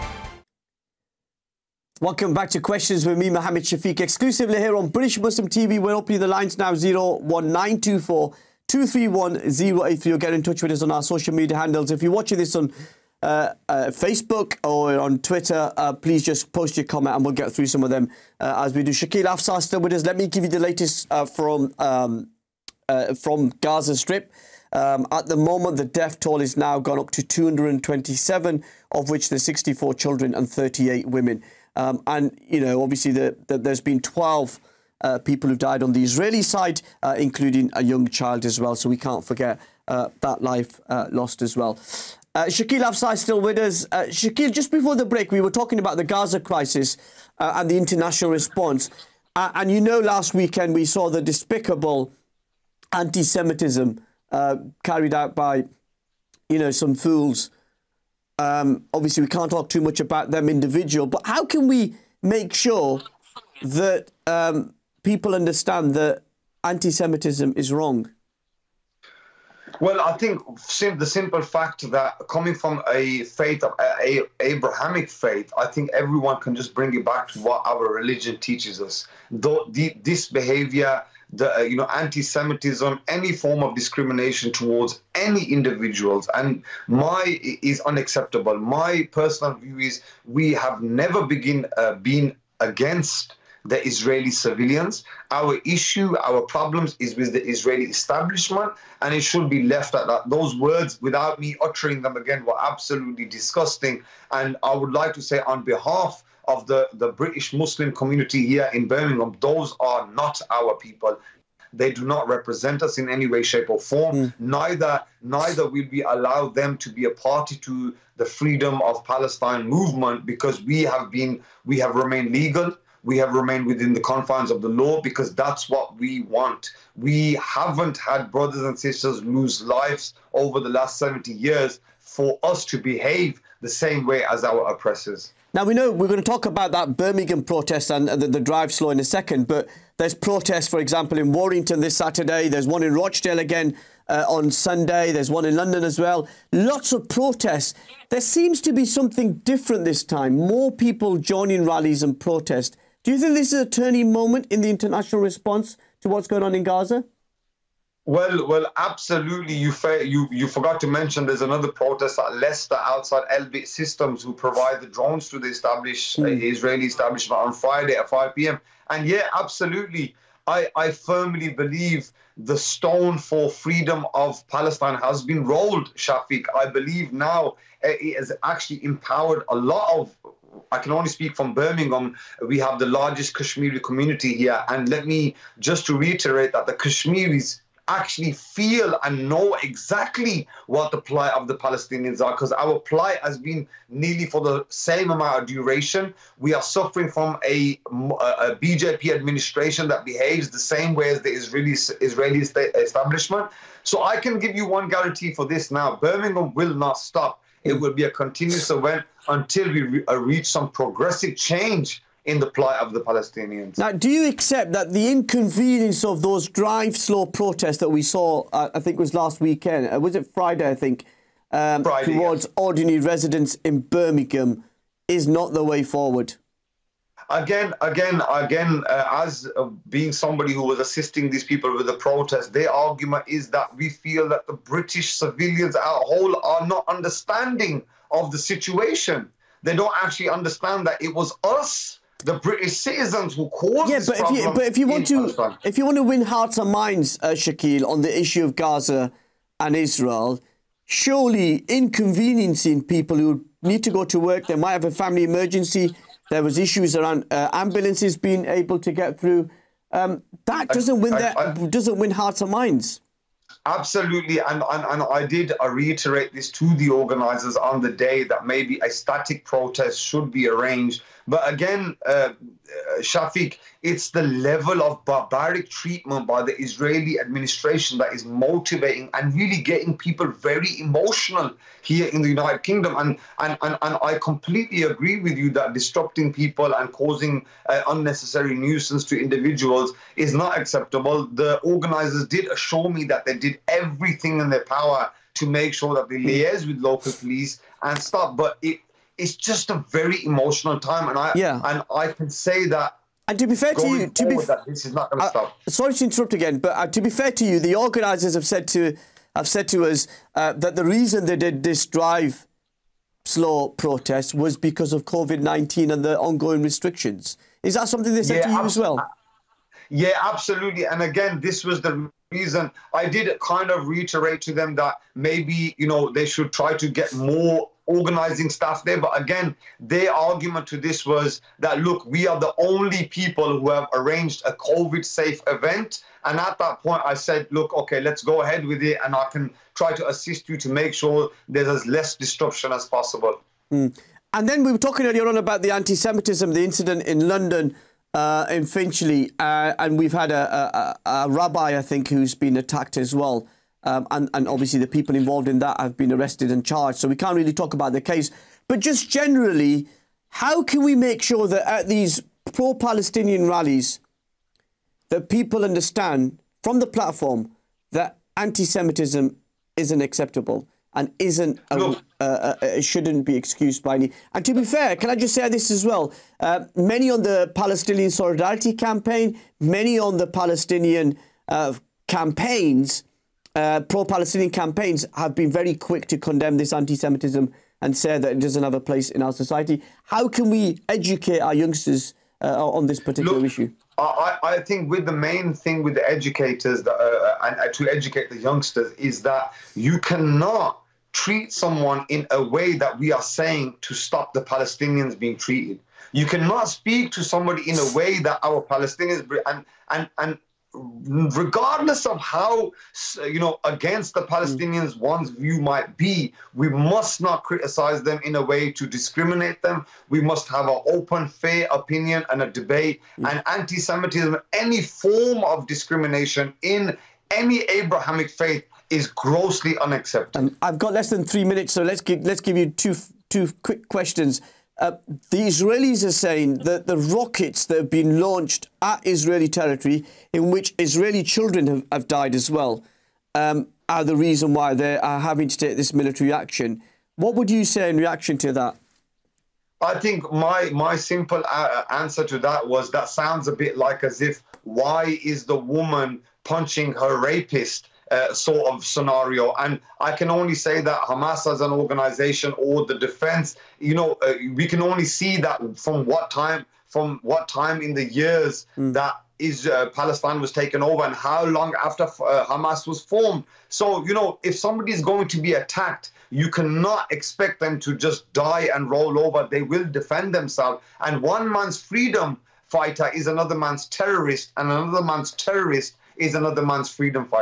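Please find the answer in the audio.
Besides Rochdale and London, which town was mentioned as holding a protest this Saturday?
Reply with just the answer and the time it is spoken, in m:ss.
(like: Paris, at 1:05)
Warrington, at 2:21.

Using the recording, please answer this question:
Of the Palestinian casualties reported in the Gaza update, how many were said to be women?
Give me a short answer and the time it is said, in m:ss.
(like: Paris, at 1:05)
38, at 0:30.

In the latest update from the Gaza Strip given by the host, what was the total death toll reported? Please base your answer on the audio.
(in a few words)
227.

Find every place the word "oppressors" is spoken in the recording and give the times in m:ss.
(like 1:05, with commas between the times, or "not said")
2:14.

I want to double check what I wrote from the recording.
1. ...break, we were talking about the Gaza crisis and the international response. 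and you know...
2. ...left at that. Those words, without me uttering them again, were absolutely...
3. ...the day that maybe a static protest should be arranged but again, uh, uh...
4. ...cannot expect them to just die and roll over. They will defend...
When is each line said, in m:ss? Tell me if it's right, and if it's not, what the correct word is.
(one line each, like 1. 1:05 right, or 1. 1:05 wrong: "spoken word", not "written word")
1. 0:45 right
2. 1:39 right
3. 4:27 right
4. 7:56 right.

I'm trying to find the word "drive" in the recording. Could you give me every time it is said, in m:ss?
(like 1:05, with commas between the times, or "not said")
2:18, 3:36, 5:11.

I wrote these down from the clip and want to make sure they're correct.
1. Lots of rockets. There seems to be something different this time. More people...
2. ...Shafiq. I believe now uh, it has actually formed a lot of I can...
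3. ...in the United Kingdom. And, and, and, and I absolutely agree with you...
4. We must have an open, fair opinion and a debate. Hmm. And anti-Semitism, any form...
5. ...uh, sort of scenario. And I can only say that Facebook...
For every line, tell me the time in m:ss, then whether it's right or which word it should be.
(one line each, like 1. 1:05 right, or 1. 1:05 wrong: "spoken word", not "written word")
1. 2:26 wrong: "protests", not "rockets"
2. 2:55 wrong: "empowered", not "formed"
3. 4:42 wrong: "completely", not "absolutely"
4. 7:00 right
5. 7:38 wrong: "Hamas", not "Facebook".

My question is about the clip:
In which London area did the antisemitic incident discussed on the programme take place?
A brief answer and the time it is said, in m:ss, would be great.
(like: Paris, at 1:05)
Finchley, at 5:48.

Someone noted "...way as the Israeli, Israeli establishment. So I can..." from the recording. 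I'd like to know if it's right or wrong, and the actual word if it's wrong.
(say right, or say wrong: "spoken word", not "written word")
right.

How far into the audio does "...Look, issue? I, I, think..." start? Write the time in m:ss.
6:33.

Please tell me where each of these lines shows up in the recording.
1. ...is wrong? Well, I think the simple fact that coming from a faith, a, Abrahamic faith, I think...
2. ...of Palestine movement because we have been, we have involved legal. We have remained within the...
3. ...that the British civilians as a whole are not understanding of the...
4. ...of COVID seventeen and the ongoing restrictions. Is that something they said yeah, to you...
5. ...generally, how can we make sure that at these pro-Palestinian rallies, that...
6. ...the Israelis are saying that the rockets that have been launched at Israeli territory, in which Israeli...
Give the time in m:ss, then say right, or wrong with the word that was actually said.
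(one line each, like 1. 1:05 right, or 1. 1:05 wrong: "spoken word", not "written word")
1. 1:07 right
2. 1:58 wrong: "remained", not "involved"
3. 3:54 right
4. 5:14 wrong: "nineteen", not "seventeen"
5. 5:59 right
6. 7:15 right.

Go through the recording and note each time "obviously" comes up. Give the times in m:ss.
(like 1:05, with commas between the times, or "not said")
0:32, 0:58, 5:54.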